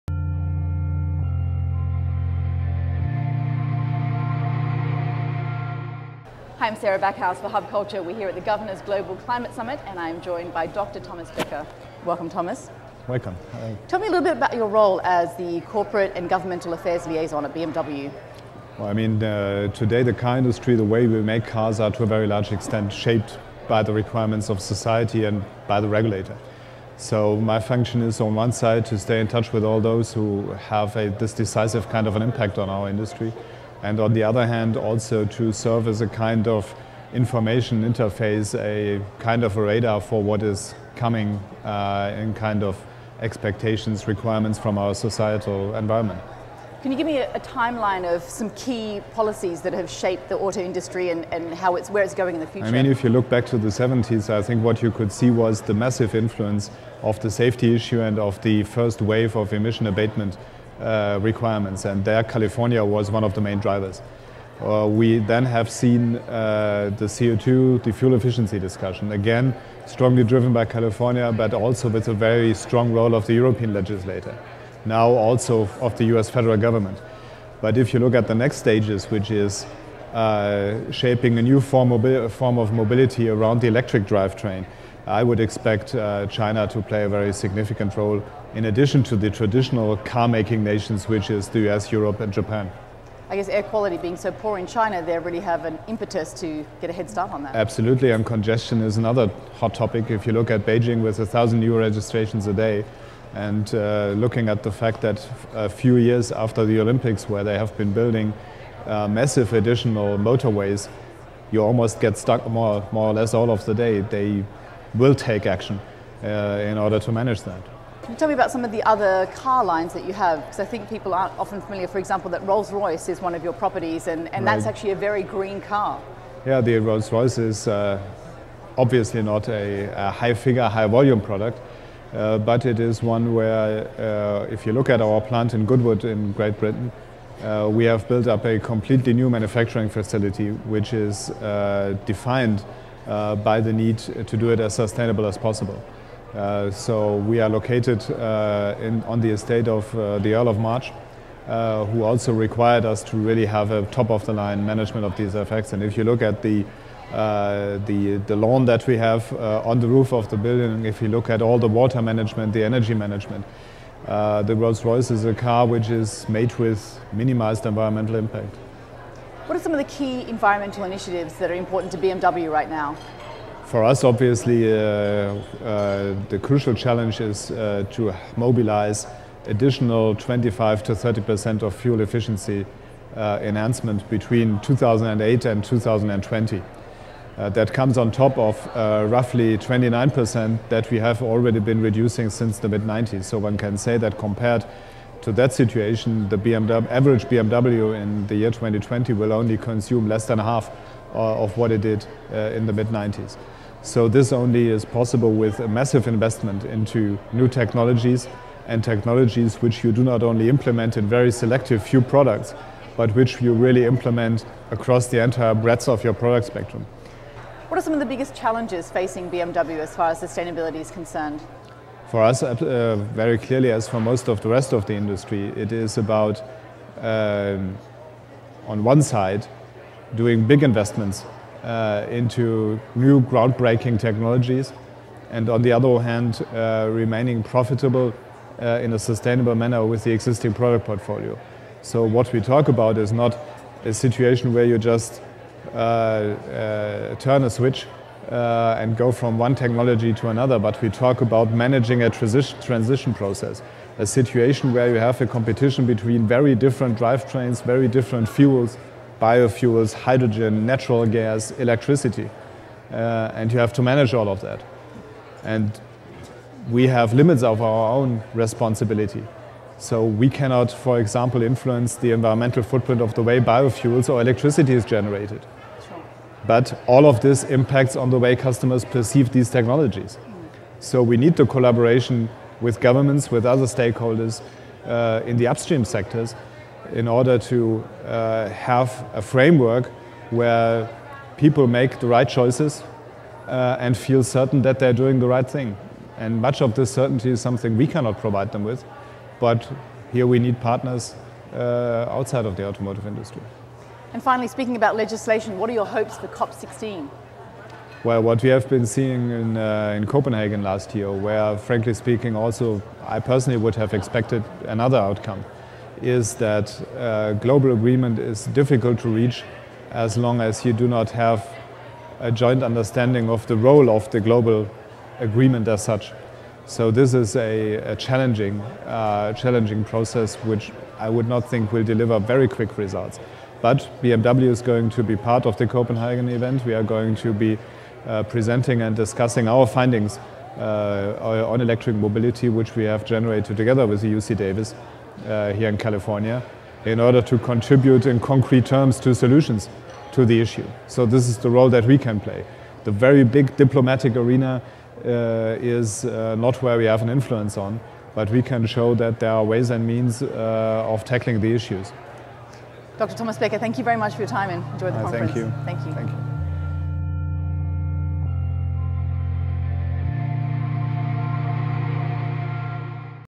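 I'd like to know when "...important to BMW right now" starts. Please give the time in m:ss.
2:51.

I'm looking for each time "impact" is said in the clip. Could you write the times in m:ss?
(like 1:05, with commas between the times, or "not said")
0:32, 2:48, 4:37.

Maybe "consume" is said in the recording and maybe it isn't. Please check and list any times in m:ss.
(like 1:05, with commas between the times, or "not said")
3:19.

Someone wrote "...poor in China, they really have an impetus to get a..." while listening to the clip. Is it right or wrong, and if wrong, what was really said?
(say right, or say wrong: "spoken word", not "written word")
right.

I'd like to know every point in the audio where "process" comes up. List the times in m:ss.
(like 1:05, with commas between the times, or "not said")
4:13, 5:29.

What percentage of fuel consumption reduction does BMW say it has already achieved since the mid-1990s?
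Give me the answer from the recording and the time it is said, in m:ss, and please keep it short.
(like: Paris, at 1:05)
29 percent, at 3:09.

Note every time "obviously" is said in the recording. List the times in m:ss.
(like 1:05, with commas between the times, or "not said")
2:08, 2:54.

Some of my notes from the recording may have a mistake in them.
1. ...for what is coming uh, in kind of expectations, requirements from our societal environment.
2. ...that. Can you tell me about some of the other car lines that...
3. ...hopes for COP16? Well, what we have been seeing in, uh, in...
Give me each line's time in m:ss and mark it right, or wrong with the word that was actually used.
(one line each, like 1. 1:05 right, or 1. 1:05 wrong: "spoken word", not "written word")
1. 0:39 right
2. 1:57 right
3. 5:05 right.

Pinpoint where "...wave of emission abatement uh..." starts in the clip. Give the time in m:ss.
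0:58.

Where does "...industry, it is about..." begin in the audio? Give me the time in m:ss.
3:44.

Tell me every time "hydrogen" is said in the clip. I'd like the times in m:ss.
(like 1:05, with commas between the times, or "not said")
4:19.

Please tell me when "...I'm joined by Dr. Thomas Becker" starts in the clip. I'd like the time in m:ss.
0:09.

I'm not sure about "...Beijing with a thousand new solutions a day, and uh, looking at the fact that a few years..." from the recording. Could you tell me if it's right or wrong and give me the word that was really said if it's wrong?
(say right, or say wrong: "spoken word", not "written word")
wrong: "registrations", not "solutions".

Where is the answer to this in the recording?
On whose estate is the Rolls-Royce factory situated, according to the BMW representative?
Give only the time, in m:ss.
2:30.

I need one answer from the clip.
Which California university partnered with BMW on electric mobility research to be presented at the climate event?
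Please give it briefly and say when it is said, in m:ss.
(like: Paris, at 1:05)
UC Davis, at 5:44.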